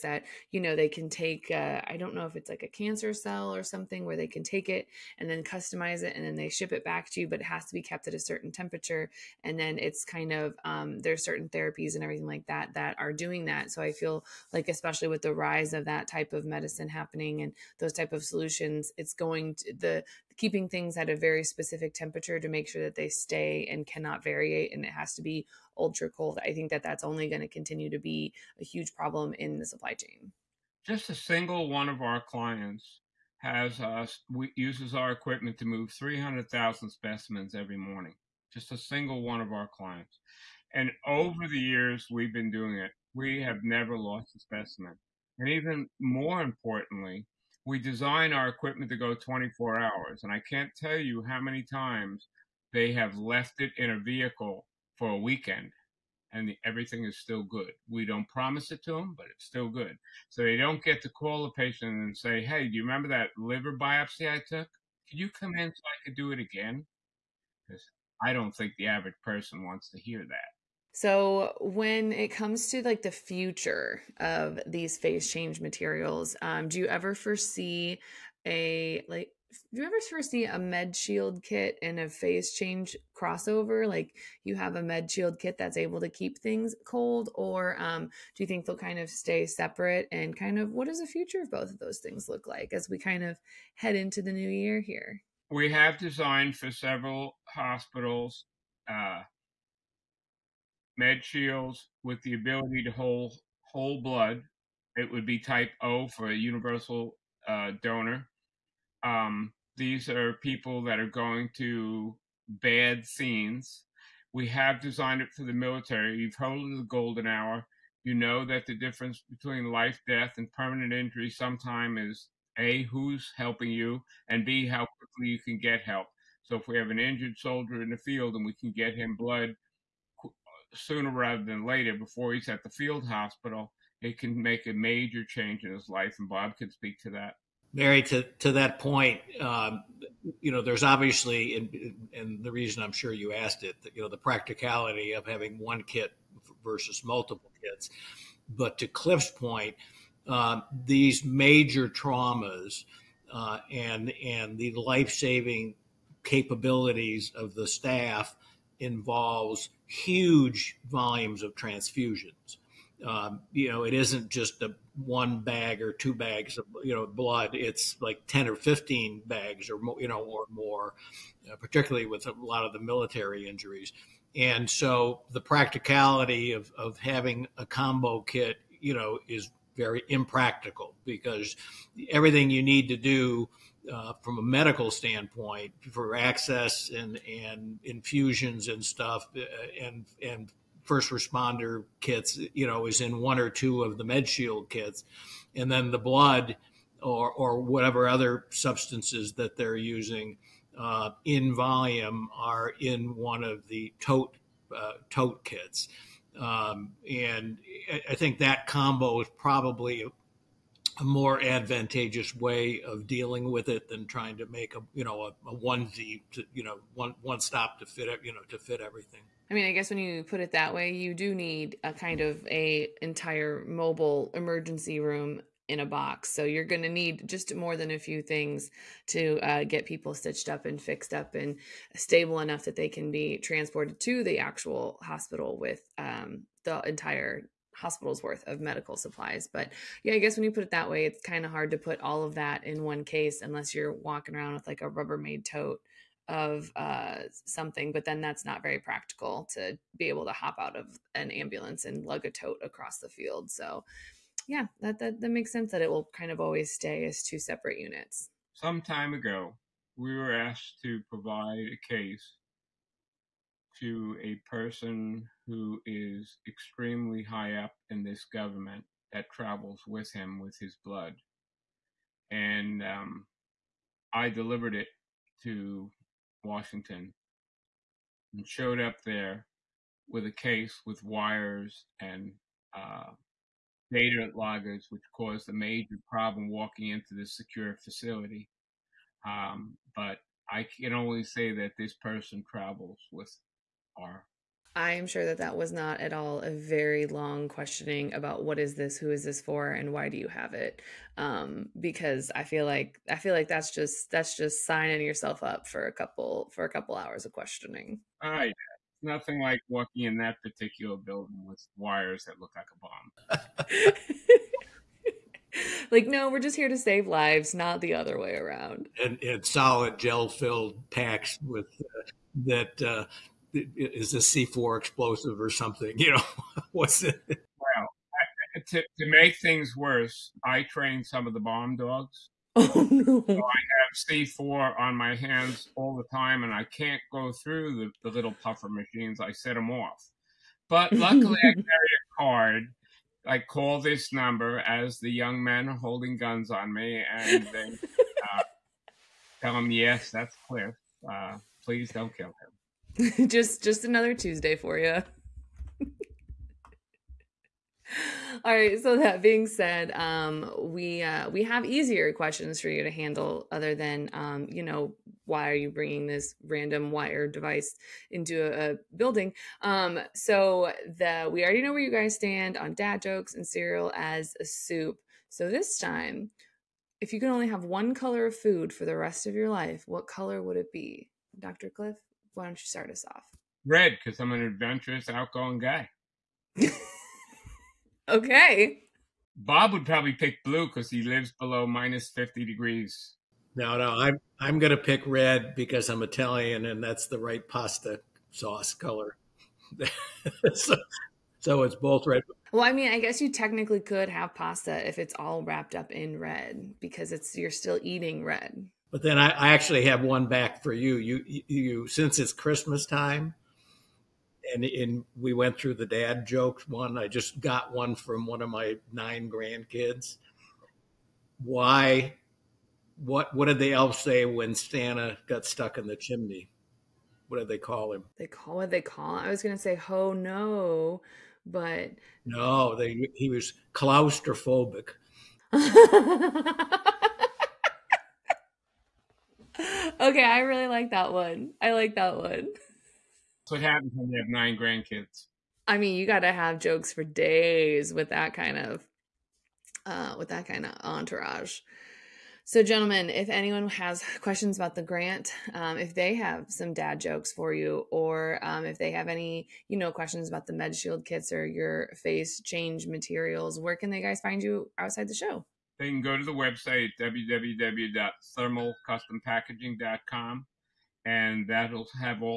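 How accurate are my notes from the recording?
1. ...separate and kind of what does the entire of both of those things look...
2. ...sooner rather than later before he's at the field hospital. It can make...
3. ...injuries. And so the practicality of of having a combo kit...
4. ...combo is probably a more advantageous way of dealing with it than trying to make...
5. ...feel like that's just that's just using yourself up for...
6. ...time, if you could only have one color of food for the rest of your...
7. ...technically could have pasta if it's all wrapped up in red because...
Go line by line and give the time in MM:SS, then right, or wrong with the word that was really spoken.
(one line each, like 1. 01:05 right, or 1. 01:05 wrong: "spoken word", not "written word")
1. 01:29 wrong: "future", not "entire"
2. 02:10 right
3. 02:53 right
4. 03:28 right
5. 05:03 wrong: "signing", not "using"
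6. 06:15 right
7. 06:43 right.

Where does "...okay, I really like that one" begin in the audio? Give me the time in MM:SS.
07:19.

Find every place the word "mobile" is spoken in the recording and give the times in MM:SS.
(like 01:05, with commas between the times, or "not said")
03:43.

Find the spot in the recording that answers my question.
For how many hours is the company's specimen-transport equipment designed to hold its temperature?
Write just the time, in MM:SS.
00:49.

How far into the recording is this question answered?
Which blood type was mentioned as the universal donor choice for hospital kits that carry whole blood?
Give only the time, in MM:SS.
01:45.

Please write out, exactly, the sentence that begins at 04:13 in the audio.
So yeah, that, that, that makes sense that it will kind of always stay as two separate units.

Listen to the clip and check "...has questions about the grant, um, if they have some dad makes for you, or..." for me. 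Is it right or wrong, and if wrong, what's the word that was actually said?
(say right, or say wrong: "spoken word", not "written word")
wrong: "jokes", not "makes".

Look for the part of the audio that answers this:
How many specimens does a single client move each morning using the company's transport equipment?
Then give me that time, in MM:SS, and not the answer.
00:35.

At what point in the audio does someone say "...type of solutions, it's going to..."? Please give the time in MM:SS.
00:17.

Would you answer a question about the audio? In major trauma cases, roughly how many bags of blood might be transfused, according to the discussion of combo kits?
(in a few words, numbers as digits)
10 or 15.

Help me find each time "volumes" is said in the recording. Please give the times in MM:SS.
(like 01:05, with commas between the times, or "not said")
02:40, 03:21.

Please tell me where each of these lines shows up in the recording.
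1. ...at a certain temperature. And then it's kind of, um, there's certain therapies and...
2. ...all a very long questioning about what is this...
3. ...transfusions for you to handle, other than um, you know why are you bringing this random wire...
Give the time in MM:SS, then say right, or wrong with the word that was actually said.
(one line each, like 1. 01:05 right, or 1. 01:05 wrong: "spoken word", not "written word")
1. 00:08 right
2. 04:56 right
3. 06:02 wrong: "questions", not "transfusions".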